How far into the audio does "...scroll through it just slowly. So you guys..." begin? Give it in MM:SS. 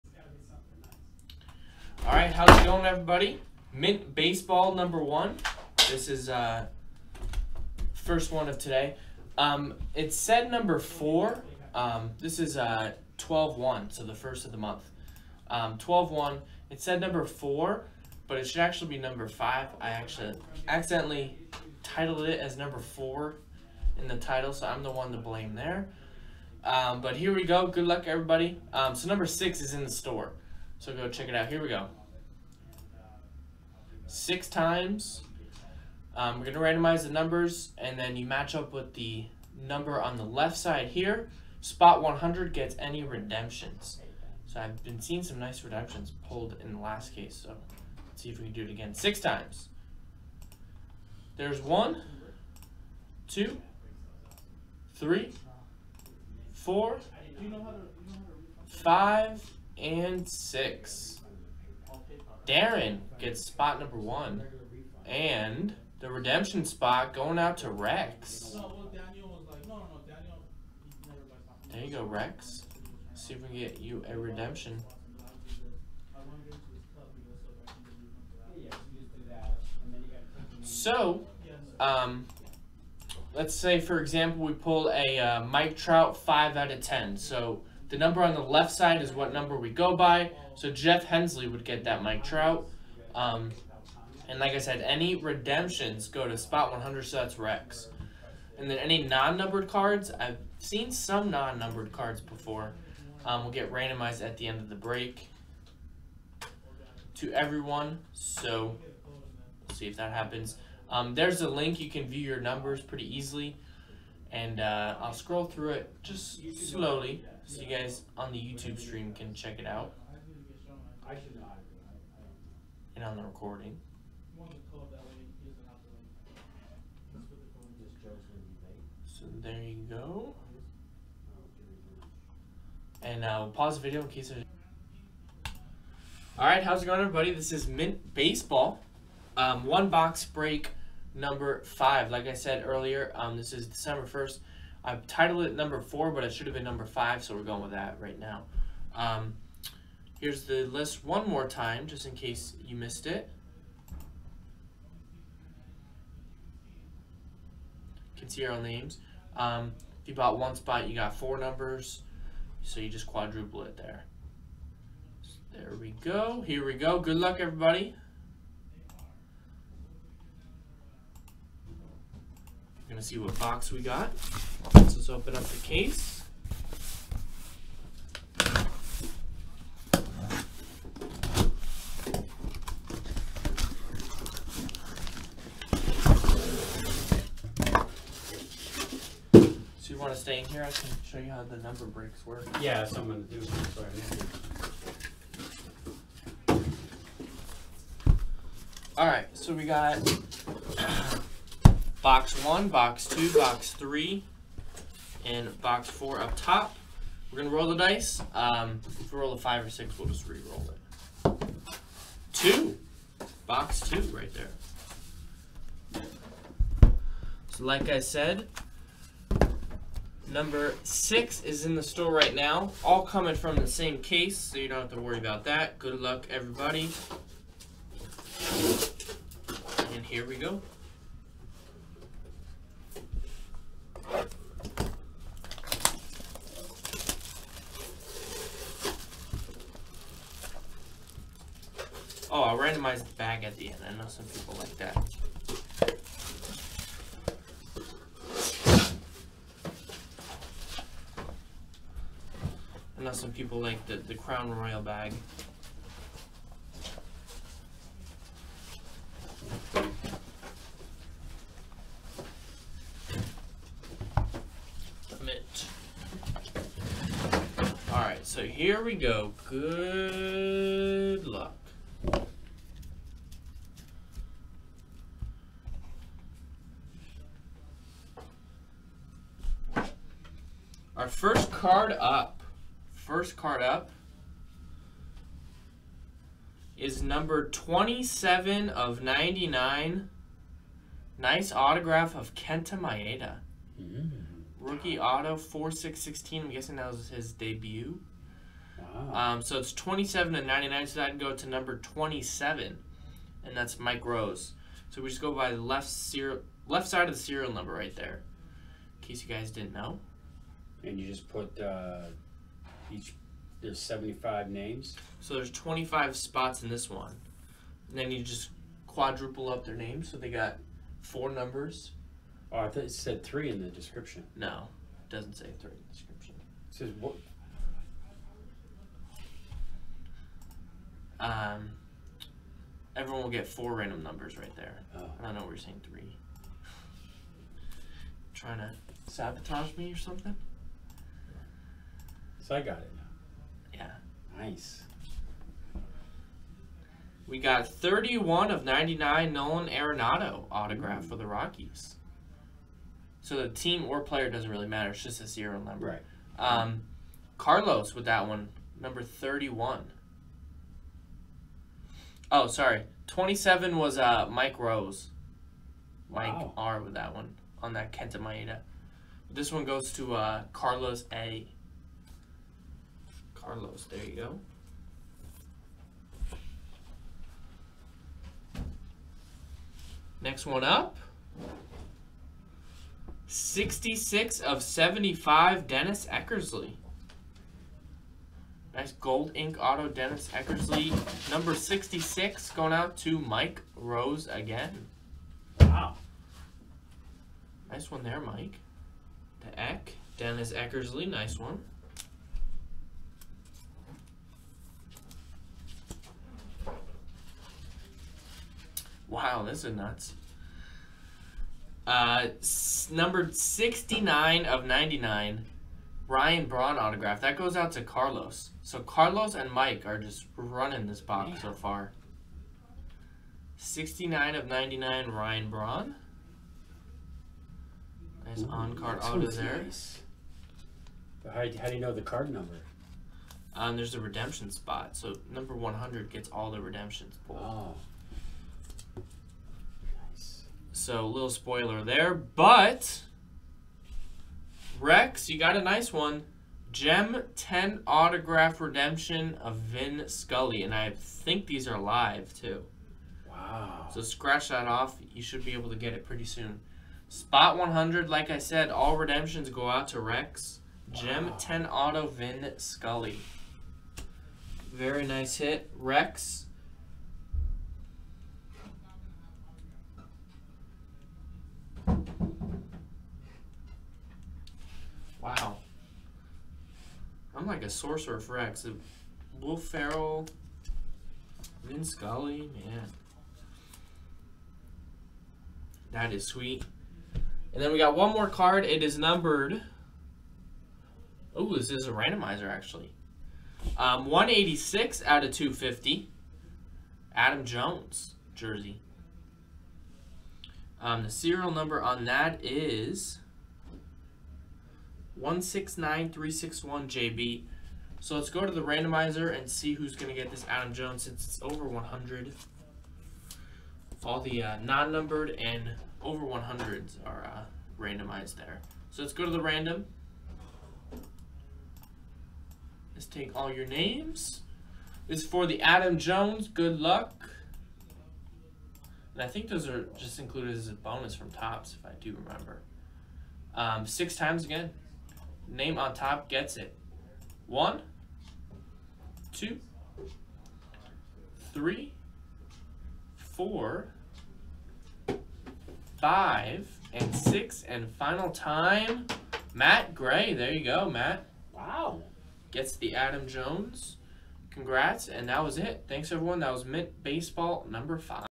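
01:55.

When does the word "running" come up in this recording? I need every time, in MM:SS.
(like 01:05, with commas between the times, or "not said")
07:00.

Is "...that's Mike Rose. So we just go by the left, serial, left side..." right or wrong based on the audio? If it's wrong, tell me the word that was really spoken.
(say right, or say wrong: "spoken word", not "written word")
right.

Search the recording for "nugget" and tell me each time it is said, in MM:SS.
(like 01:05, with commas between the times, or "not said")
not said.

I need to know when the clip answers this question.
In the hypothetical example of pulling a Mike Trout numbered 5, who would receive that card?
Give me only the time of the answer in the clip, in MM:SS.
01:30.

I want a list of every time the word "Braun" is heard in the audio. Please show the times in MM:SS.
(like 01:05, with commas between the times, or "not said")
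06:56, 07:05.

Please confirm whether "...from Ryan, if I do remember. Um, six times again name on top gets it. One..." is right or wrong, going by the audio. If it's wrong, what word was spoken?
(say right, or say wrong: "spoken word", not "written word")
wrong: "Topps", not "Ryan".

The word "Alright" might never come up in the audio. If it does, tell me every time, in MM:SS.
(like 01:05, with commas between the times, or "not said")
02:16, 04:27.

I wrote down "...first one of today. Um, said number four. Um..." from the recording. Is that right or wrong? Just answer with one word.
right.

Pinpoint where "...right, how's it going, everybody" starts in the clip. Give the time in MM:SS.
00:02.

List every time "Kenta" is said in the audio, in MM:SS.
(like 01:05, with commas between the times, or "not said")
04:52, 06:07.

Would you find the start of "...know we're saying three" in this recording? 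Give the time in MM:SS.
05:35.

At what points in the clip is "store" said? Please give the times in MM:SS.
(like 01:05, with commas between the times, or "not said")
00:29, 03:41.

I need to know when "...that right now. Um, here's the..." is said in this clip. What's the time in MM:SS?
02:27.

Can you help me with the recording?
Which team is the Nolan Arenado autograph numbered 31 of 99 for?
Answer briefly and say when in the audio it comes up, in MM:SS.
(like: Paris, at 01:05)
Rockies, at 05:51.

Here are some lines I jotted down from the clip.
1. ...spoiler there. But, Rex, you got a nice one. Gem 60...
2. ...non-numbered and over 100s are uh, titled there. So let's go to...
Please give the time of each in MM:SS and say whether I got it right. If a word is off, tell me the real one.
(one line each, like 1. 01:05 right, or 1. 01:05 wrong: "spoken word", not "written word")
1. 07:21 wrong: "10", not "60"
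2. 08:34 wrong: "randomized", not "titled".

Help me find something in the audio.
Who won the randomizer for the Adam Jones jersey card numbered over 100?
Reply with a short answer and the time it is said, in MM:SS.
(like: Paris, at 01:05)
Matt Gray, at 09:09.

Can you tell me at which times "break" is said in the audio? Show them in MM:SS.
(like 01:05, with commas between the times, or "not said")
01:44, 02:20, 03:11.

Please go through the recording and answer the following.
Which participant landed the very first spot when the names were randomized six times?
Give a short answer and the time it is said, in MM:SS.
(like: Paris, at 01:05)
Darren, at 01:02.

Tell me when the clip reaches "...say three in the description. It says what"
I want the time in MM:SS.
05:25.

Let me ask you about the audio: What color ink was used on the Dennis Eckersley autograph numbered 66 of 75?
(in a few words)
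Gold.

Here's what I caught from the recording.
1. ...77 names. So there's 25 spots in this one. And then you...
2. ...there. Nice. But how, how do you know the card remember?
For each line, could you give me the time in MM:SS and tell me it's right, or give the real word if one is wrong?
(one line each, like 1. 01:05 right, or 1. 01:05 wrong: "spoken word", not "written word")
1. 05:13 wrong: "75", not "77"
2. 07:09 wrong: "number", not "remember".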